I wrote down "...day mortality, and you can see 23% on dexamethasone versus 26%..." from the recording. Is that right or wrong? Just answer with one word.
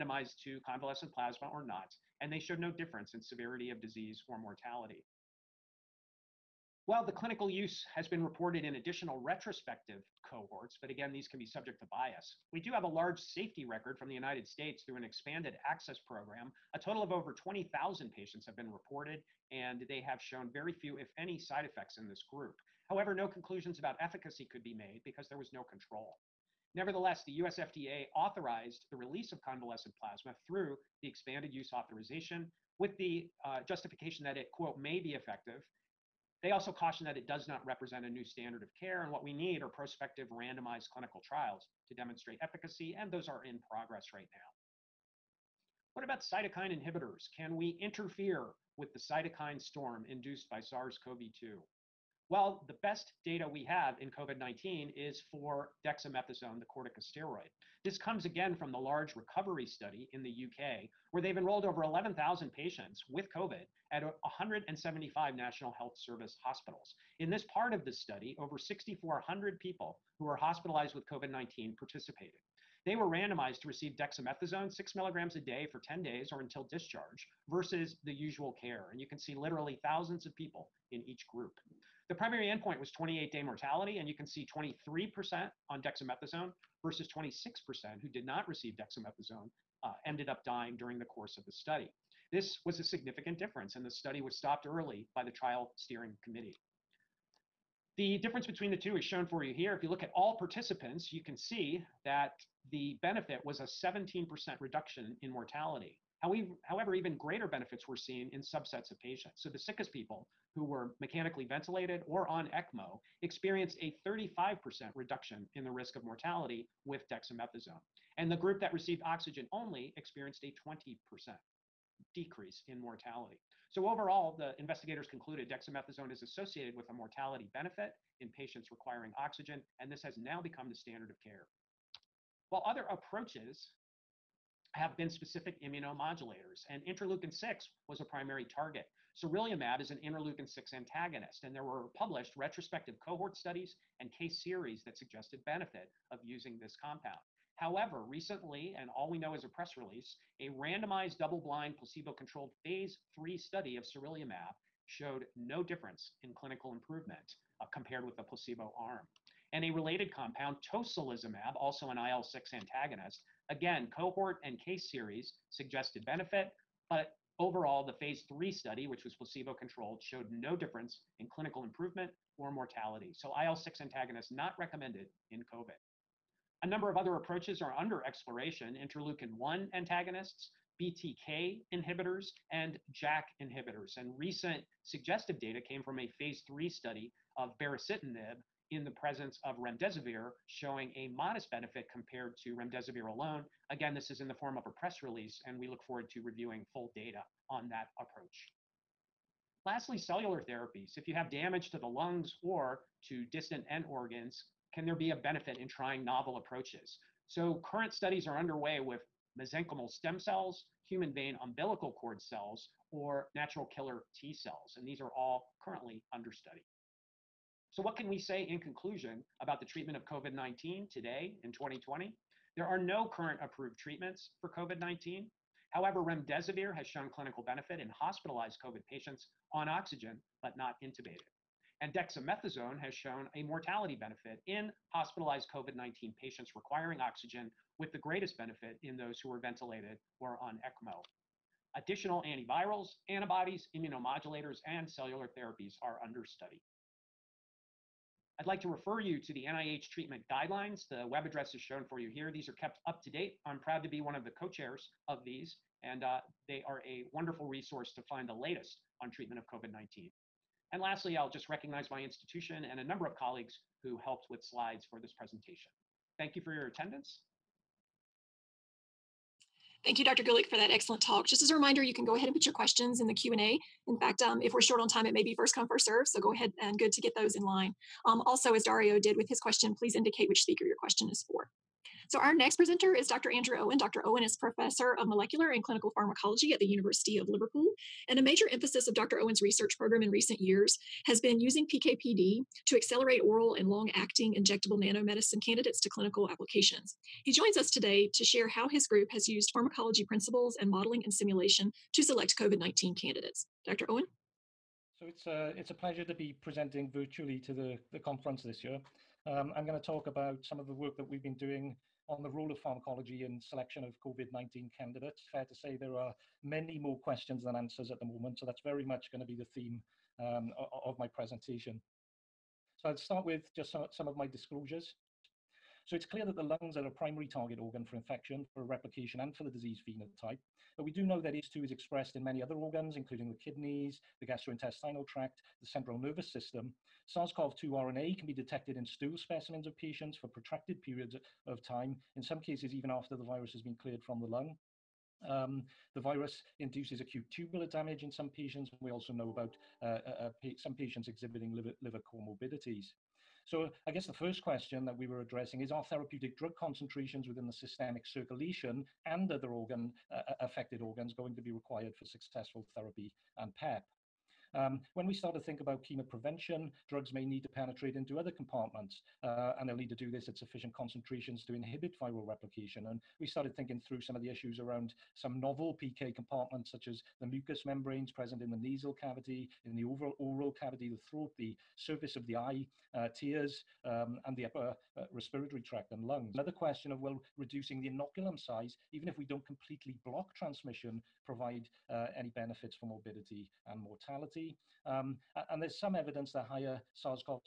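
right.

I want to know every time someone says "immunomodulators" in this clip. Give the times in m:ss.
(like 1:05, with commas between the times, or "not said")
2:15, 4:03.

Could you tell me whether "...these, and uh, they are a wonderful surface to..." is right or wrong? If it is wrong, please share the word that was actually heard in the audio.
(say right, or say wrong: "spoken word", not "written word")
wrong: "resource", not "surface".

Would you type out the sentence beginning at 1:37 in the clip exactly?
The difference between the two is shown for you here.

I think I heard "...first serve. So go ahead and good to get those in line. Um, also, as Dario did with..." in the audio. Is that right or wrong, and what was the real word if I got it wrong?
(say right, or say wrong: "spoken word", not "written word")
right.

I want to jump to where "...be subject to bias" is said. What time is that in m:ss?
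0:11.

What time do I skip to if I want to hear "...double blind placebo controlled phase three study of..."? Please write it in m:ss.
2:31.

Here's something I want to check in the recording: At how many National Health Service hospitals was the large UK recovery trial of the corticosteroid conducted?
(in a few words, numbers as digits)
175.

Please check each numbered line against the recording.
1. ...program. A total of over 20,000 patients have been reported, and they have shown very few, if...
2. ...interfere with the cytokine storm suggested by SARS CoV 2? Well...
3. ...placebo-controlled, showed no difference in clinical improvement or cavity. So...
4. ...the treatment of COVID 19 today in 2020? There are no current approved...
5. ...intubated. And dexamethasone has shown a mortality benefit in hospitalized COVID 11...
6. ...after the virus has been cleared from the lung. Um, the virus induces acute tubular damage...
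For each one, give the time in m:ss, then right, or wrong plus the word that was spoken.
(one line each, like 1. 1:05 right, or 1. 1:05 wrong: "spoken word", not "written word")
1. 0:16 right
2. 0:47 wrong: "induced", not "suggested"
3. 2:49 wrong: "mortality", not "cavity"
4. 3:39 right
5. 3:50 wrong: "19", not "11"
6. 5:42 right.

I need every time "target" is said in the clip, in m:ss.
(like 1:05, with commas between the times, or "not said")
2:18, 5:27.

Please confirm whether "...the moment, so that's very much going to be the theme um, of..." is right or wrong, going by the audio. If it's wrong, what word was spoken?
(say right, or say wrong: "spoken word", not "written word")
right.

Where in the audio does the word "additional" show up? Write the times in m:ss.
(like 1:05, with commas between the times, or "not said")
0:08, 4:01.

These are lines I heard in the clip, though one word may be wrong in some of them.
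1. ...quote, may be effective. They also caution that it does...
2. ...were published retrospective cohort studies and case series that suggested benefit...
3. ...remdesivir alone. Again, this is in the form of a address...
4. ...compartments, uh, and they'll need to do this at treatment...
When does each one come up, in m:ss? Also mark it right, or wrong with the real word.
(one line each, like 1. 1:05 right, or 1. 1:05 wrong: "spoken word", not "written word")
1. 0:34 right
2. 2:21 right
3. 3:12 wrong: "press", not "address"
4. 6:08 wrong: "sufficient", not "treatment".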